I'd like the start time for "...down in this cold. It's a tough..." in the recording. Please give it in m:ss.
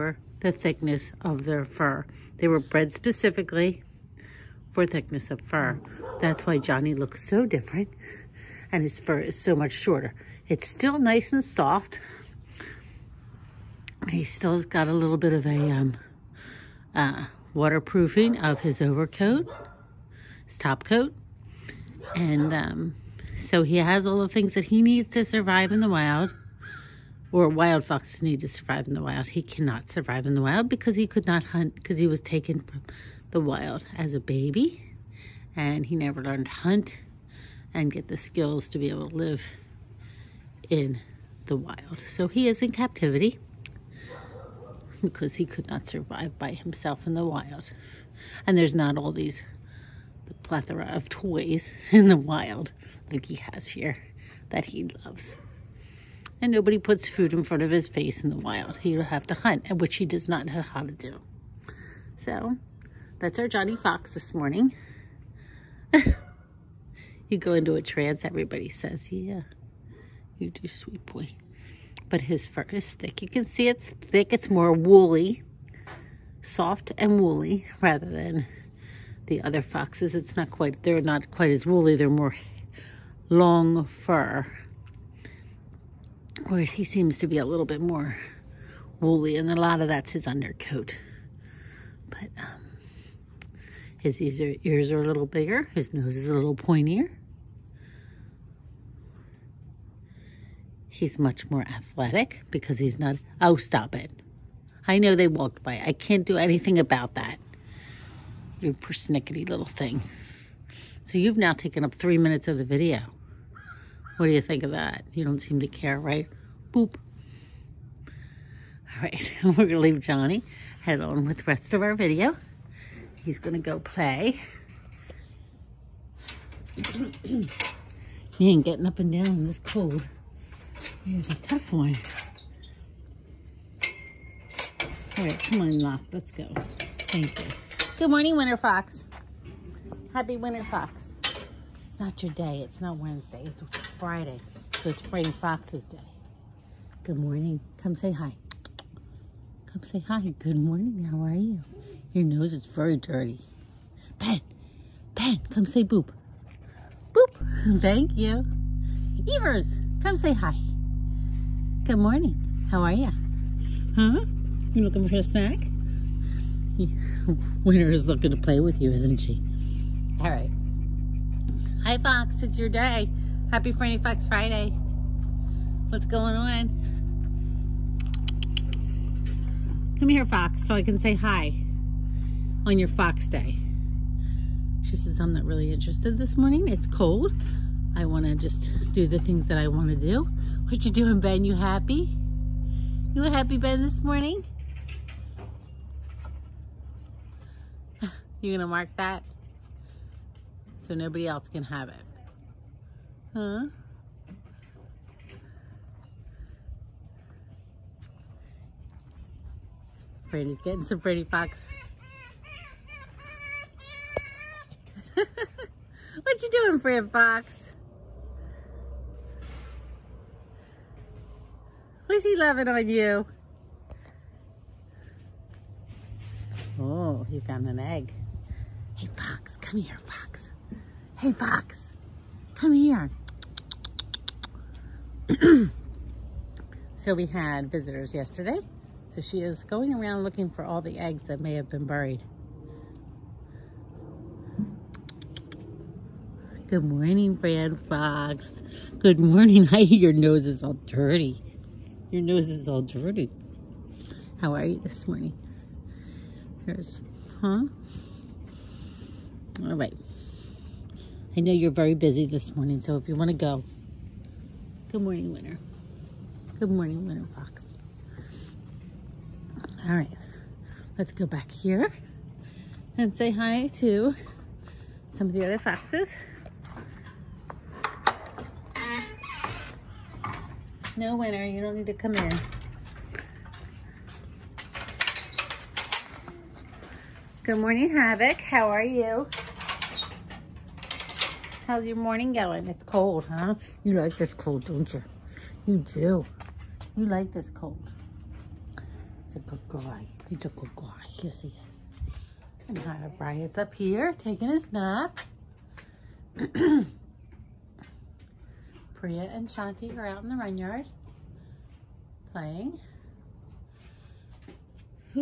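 2:09.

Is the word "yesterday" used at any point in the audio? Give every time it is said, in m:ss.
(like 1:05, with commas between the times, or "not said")
3:58.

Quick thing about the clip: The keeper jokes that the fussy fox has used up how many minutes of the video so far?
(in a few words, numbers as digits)
3.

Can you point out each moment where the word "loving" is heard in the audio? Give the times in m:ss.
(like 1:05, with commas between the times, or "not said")
3:42.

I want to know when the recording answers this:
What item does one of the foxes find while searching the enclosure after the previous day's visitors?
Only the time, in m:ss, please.
3:47.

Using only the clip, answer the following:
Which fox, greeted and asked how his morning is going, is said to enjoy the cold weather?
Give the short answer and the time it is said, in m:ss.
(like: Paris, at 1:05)
Havoc, at 4:47.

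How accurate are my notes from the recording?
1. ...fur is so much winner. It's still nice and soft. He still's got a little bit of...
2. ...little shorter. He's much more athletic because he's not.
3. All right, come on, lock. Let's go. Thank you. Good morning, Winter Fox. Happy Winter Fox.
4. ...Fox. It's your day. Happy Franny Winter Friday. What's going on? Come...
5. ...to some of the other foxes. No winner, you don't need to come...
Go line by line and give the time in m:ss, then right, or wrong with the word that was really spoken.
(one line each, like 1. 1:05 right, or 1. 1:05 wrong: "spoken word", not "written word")
1. 0:08 wrong: "shorter", not "winner"
2. 1:36 wrong: "pointier", not "shorter"
3. 2:15 right
4. 2:51 wrong: "Fox", not "Winter"
5. 4:33 right.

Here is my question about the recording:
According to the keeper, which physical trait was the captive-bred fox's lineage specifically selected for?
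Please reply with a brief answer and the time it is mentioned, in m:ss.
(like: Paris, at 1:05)
thickness of fur, at 0:04.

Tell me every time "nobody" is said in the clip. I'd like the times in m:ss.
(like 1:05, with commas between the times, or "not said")
0:56, 3:20.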